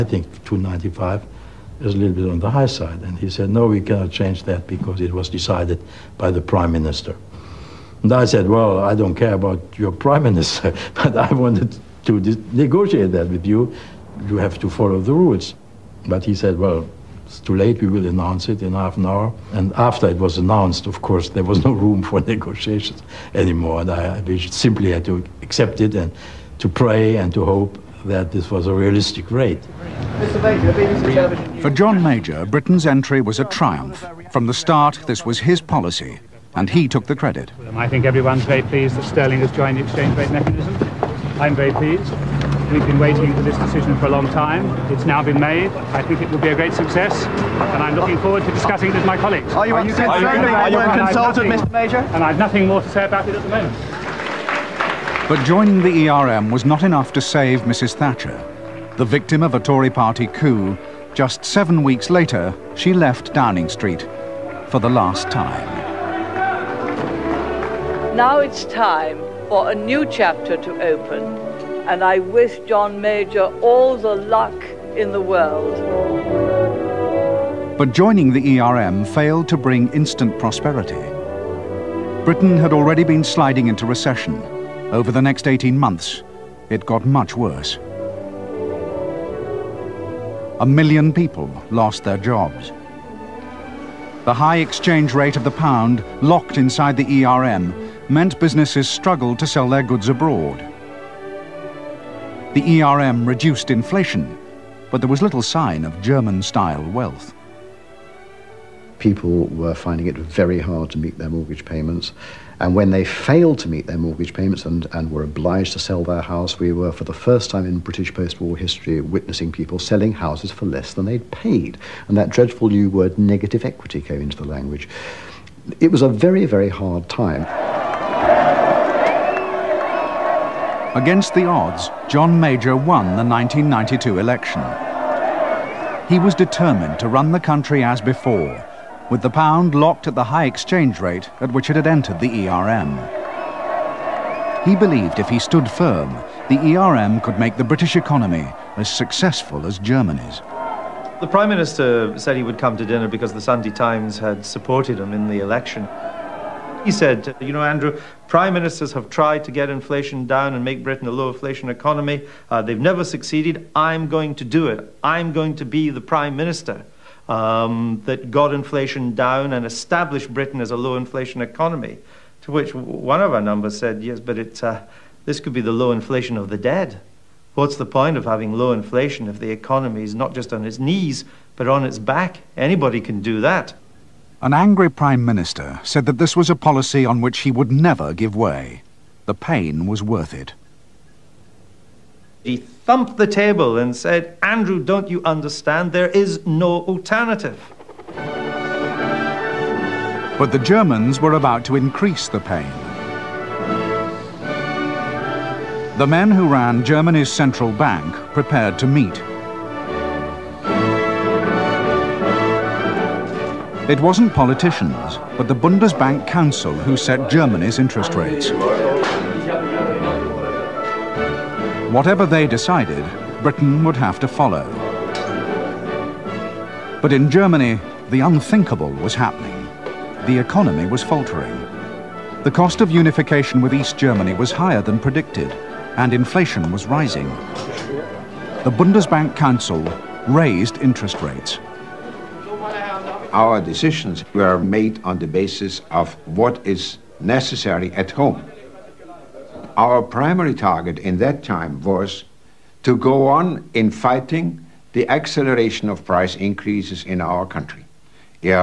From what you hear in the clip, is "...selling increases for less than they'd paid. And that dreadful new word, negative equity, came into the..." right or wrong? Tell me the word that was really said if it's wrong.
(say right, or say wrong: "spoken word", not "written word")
wrong: "houses", not "increases".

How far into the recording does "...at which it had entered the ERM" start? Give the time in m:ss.
2:21.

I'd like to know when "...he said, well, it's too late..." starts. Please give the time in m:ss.
0:16.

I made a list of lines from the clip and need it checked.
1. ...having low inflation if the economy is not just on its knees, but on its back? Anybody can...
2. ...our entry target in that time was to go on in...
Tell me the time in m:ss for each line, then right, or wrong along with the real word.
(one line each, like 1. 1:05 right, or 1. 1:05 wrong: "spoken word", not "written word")
1. 2:58 right
2. 4:09 wrong: "primary", not "entry".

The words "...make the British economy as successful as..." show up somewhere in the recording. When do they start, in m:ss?
2:27.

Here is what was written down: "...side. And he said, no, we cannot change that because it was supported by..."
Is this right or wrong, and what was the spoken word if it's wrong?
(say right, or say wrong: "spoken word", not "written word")
wrong: "decided", not "supported".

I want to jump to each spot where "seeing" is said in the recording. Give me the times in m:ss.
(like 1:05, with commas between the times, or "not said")
not said.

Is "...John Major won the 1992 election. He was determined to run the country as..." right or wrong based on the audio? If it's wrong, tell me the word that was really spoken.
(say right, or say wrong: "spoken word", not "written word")
right.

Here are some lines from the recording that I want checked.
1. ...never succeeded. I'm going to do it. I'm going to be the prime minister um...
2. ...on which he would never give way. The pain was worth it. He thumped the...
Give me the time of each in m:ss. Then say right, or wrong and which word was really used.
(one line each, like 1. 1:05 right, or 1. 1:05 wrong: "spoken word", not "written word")
1. 2:42 right
2. 3:07 right.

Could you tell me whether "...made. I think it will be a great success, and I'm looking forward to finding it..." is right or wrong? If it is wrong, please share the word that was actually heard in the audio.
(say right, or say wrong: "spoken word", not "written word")
wrong: "discussing", not "finding".